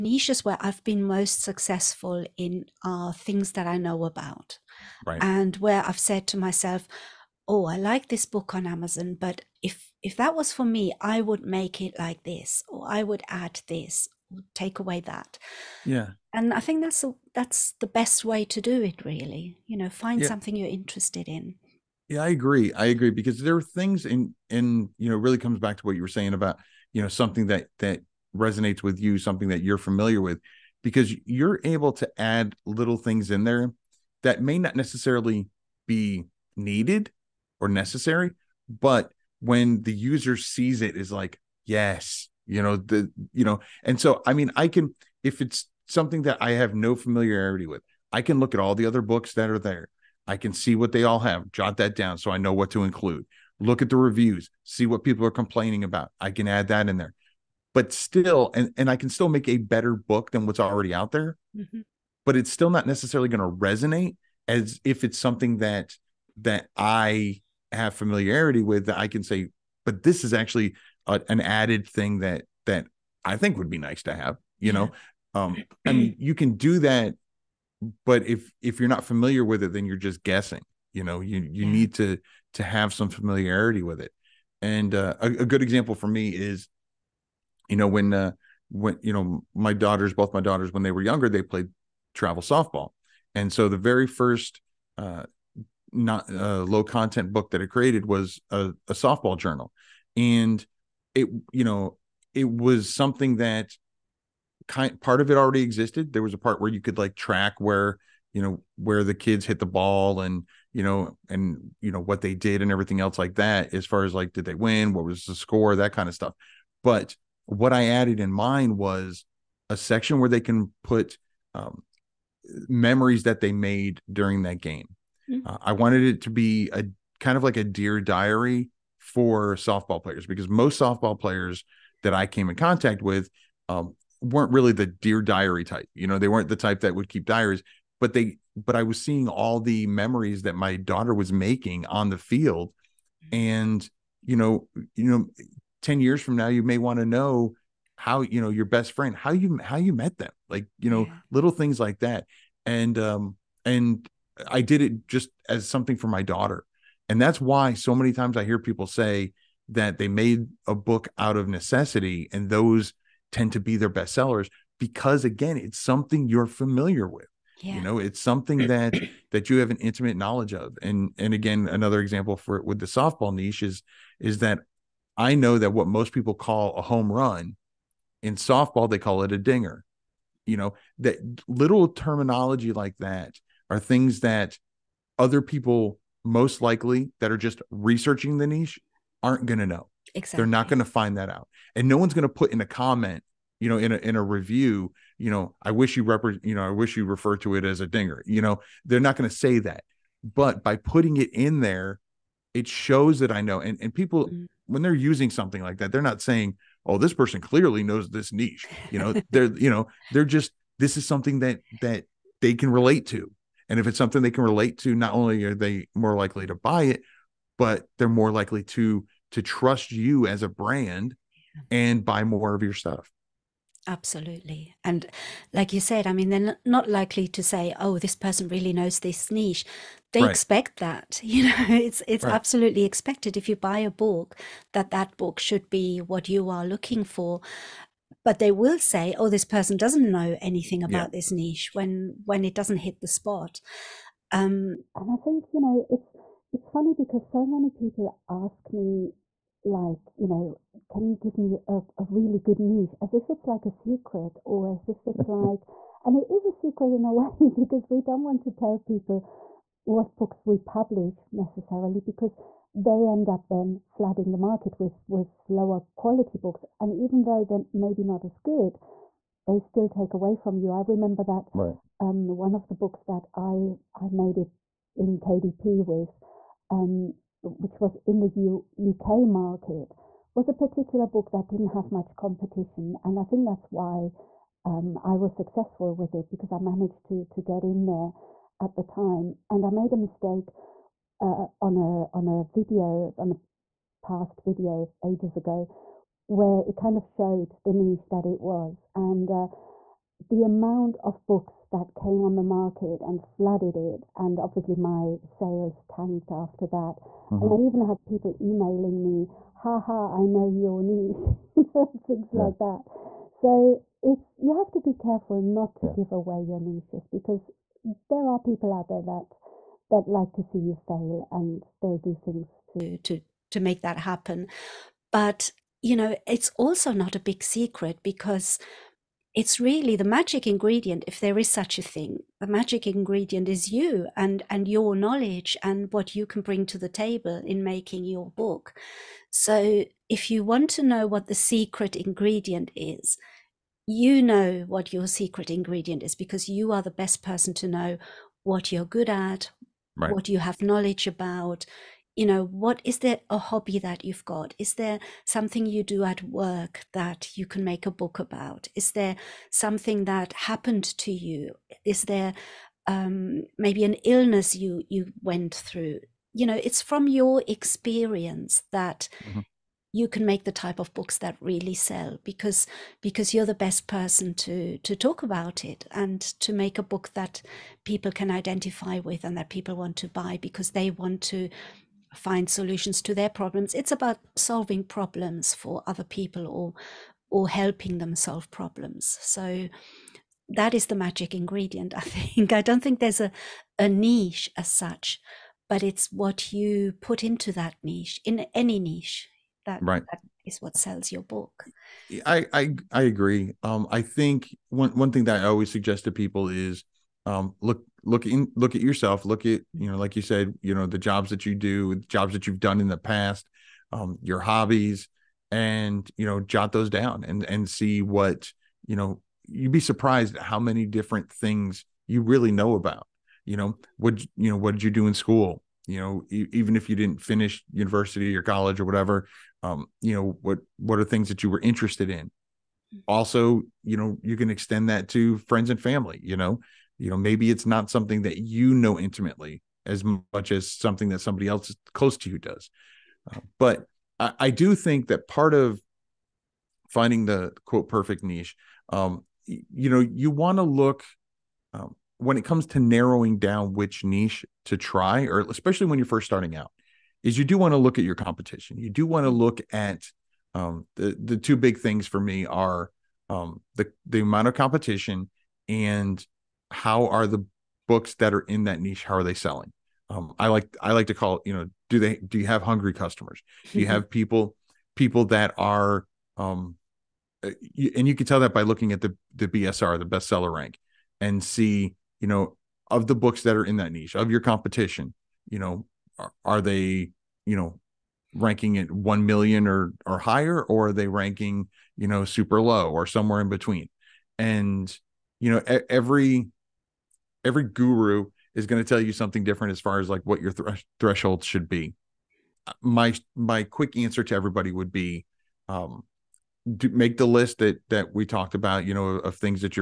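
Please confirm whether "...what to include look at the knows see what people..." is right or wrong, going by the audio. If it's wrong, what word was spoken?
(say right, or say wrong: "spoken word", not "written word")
wrong: "reviews", not "knows".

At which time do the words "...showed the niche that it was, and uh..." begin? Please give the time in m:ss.
4:57.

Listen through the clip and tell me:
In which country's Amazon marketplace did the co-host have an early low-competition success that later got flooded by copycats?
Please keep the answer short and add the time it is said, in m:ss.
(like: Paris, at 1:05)
UK, at 4:38.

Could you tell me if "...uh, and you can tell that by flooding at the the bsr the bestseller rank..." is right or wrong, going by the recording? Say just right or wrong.
wrong.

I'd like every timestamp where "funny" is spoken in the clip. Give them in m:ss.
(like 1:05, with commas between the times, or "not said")
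4:06.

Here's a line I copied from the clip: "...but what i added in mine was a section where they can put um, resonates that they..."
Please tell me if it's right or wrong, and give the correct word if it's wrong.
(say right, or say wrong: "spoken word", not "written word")
wrong: "memories", not "resonates".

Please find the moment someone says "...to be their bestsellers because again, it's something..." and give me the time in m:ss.
2:43.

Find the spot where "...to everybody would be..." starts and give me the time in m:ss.
8:24.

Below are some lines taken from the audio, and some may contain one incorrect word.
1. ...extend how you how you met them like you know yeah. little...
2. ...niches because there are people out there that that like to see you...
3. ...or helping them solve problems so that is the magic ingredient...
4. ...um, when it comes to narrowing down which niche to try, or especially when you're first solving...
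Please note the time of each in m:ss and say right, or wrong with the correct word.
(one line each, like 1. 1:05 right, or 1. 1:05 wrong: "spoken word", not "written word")
1. 2:28 wrong: "friend", not "extend"
2. 5:16 right
3. 6:27 right
4. 7:31 wrong: "starting", not "solving".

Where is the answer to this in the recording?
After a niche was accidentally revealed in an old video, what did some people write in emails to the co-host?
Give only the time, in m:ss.
5:09.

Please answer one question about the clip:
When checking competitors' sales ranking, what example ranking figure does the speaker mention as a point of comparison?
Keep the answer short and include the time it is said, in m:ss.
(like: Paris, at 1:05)
1 million, at 8:08.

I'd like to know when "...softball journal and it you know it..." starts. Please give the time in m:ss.
1:38.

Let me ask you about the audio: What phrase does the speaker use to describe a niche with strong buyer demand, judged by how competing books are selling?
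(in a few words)
Hungry customers.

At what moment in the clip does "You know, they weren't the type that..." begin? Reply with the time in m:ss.
2:15.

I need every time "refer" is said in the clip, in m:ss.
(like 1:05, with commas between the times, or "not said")
3:17.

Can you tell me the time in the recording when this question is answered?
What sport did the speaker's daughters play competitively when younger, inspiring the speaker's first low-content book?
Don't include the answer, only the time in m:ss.
1:32.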